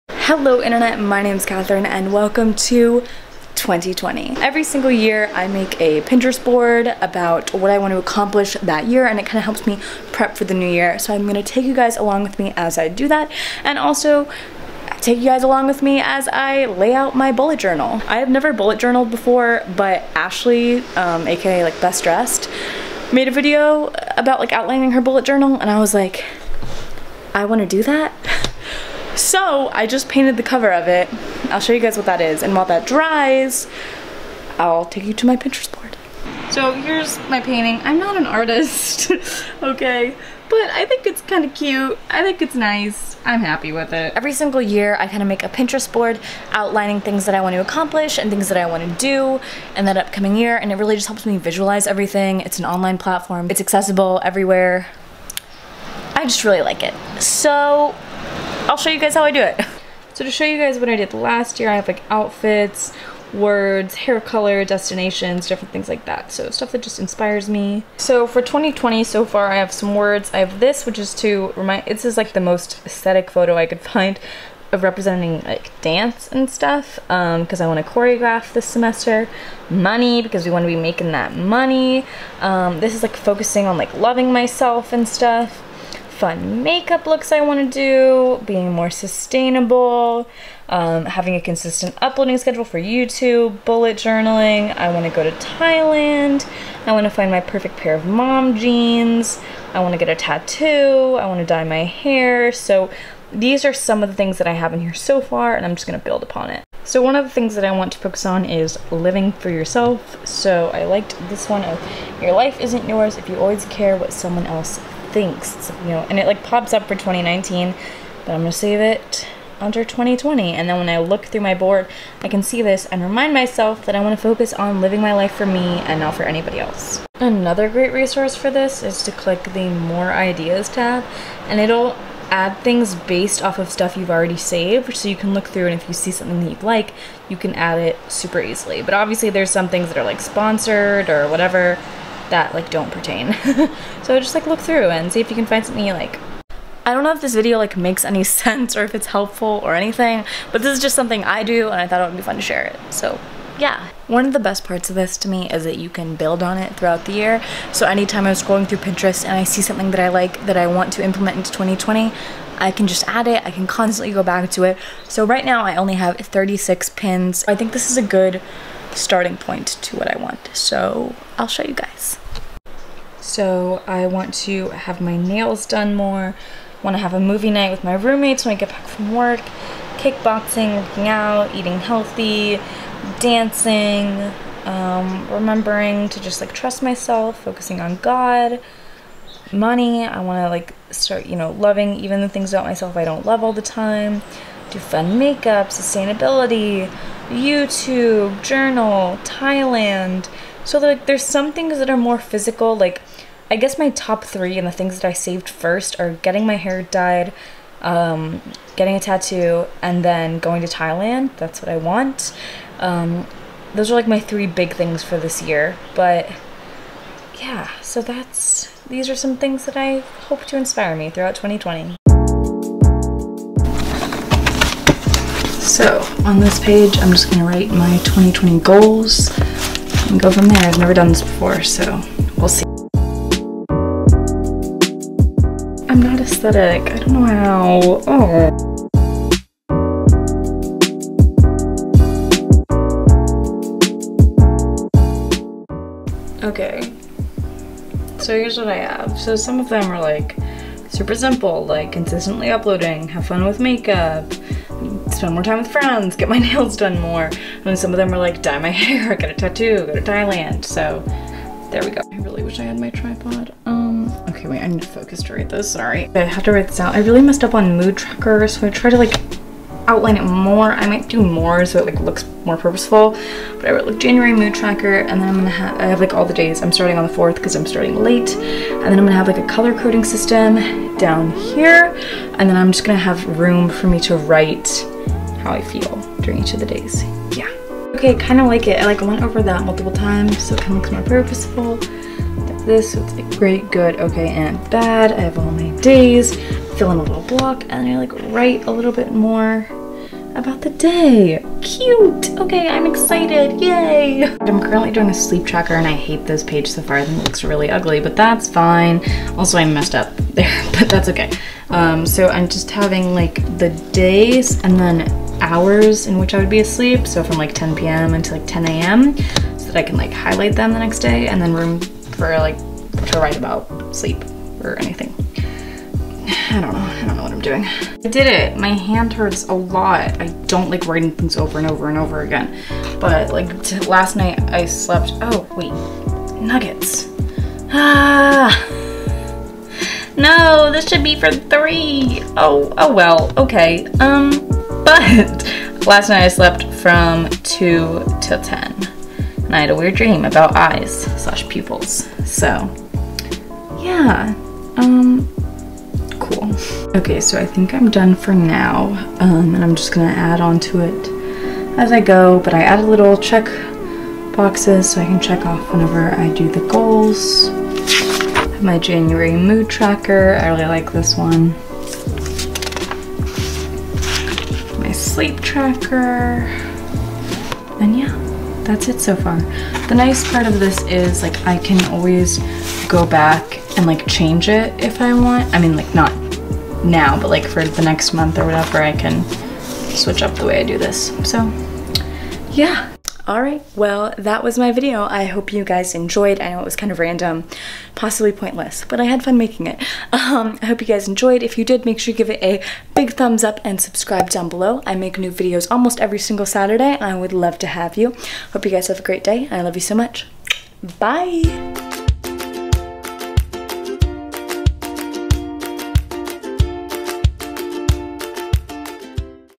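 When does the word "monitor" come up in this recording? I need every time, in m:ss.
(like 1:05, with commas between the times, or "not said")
not said.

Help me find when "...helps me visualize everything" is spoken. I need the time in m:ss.
0:51.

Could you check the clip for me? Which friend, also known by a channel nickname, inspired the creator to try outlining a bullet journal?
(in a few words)
Ashley.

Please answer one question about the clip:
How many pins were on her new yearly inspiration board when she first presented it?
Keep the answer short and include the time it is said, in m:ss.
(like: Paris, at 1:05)
36, at 2:46.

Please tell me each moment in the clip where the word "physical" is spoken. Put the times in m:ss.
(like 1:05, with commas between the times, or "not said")
3:22.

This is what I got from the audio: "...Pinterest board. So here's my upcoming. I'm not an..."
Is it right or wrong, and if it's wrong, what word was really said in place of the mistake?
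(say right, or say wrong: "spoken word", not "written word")
wrong: "painting", not "upcoming".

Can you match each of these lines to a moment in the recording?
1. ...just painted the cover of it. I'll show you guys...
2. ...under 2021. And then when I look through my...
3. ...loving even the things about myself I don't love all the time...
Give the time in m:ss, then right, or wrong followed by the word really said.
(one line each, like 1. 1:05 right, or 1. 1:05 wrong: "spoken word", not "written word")
1. 0:29 right
2. 1:59 wrong: "2020", not "2021"
3. 3:11 right.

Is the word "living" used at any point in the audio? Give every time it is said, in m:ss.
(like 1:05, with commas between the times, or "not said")
1:48, 2:04.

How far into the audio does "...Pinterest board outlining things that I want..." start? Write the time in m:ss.
0:45.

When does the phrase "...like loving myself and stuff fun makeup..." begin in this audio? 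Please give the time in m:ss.
1:23.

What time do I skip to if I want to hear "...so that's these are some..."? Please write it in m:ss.
3:37.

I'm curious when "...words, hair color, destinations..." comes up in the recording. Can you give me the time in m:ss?
1:03.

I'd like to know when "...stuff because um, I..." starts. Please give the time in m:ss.
1:16.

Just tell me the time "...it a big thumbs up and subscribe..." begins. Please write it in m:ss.
6:42.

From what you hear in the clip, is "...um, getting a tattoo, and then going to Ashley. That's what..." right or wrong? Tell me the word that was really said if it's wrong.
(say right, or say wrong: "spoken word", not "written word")
wrong: "Thailand", not "Ashley".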